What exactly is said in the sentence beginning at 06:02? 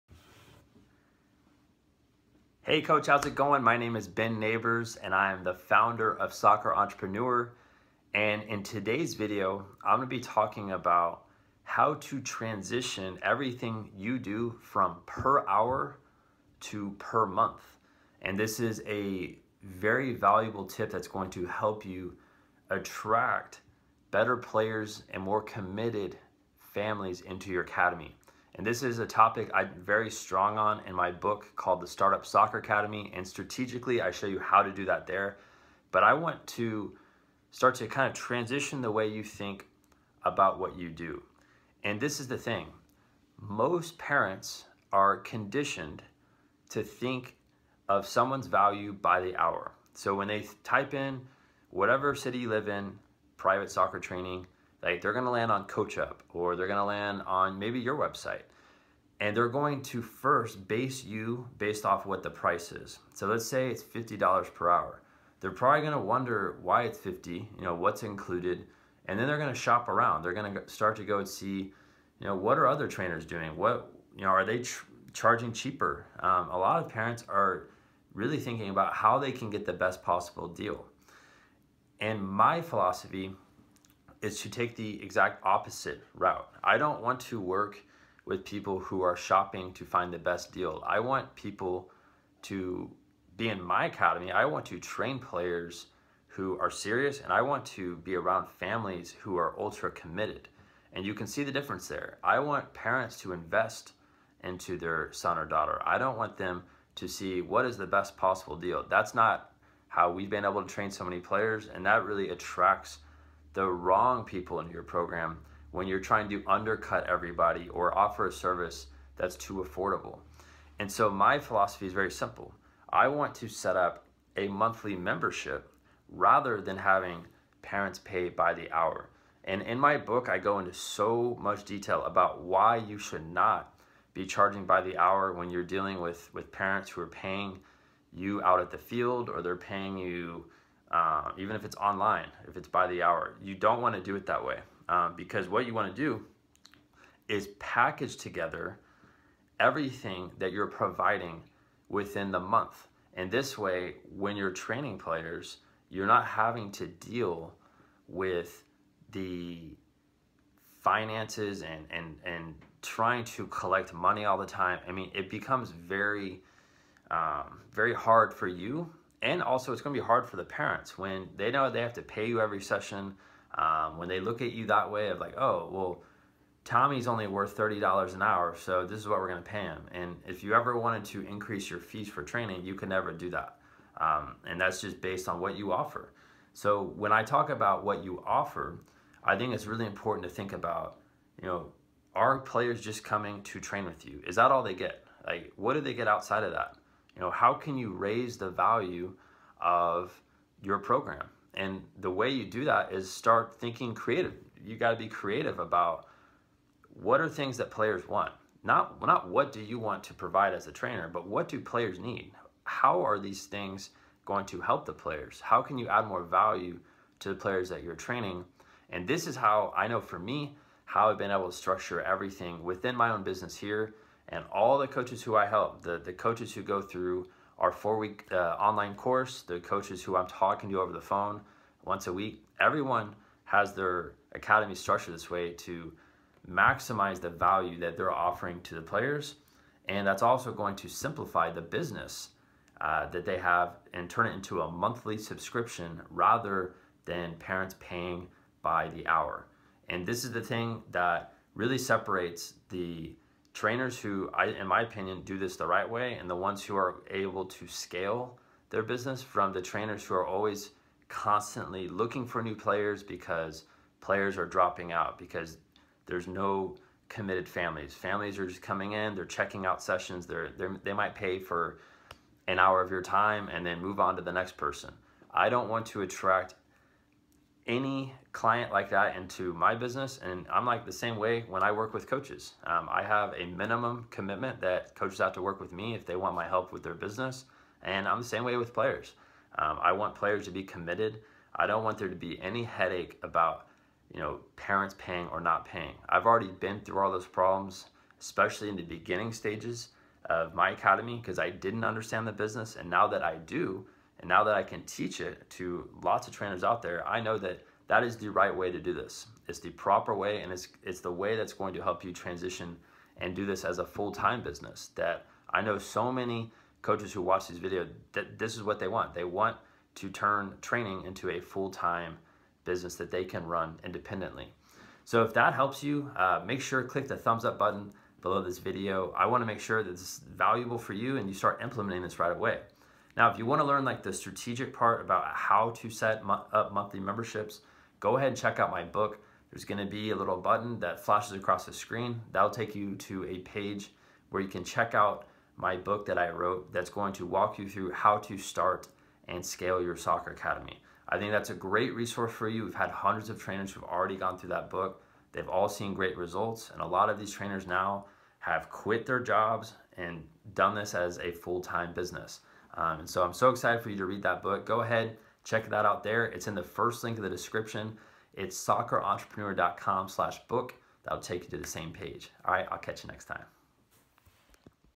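Um, and so I'm so excited for you to read that book.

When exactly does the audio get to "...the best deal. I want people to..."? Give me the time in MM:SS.
01:30.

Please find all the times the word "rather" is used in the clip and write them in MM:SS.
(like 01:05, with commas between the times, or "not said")
02:06, 04:06.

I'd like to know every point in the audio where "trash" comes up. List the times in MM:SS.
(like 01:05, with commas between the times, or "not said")
not said.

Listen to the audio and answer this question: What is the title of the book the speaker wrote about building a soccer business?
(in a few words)
The Startup Soccer Academy.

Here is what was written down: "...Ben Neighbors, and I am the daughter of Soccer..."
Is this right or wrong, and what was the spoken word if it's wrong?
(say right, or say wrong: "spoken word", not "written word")
wrong: "founder", not "daughter".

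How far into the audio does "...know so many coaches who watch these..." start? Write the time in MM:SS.
05:15.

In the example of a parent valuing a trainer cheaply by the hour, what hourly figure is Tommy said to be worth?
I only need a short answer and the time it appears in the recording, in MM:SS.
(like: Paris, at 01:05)
$30, at 02:57.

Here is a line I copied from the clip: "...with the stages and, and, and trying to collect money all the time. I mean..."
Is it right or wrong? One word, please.
wrong.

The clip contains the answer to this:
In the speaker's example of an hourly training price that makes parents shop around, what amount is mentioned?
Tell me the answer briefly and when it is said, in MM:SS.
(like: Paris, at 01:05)
$50, at 01:03.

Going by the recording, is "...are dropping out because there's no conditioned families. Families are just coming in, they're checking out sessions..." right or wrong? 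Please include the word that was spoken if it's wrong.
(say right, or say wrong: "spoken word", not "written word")
wrong: "committed", not "conditioned".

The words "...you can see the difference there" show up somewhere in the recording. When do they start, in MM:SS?
01:41.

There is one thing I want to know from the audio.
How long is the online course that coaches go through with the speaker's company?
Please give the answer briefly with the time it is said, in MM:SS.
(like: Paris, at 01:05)
4 weeks, at 03:47.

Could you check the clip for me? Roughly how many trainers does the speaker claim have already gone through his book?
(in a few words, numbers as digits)
hundreds.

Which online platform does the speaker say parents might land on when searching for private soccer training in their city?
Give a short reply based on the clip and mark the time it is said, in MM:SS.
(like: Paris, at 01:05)
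CoachUp, at 00:55.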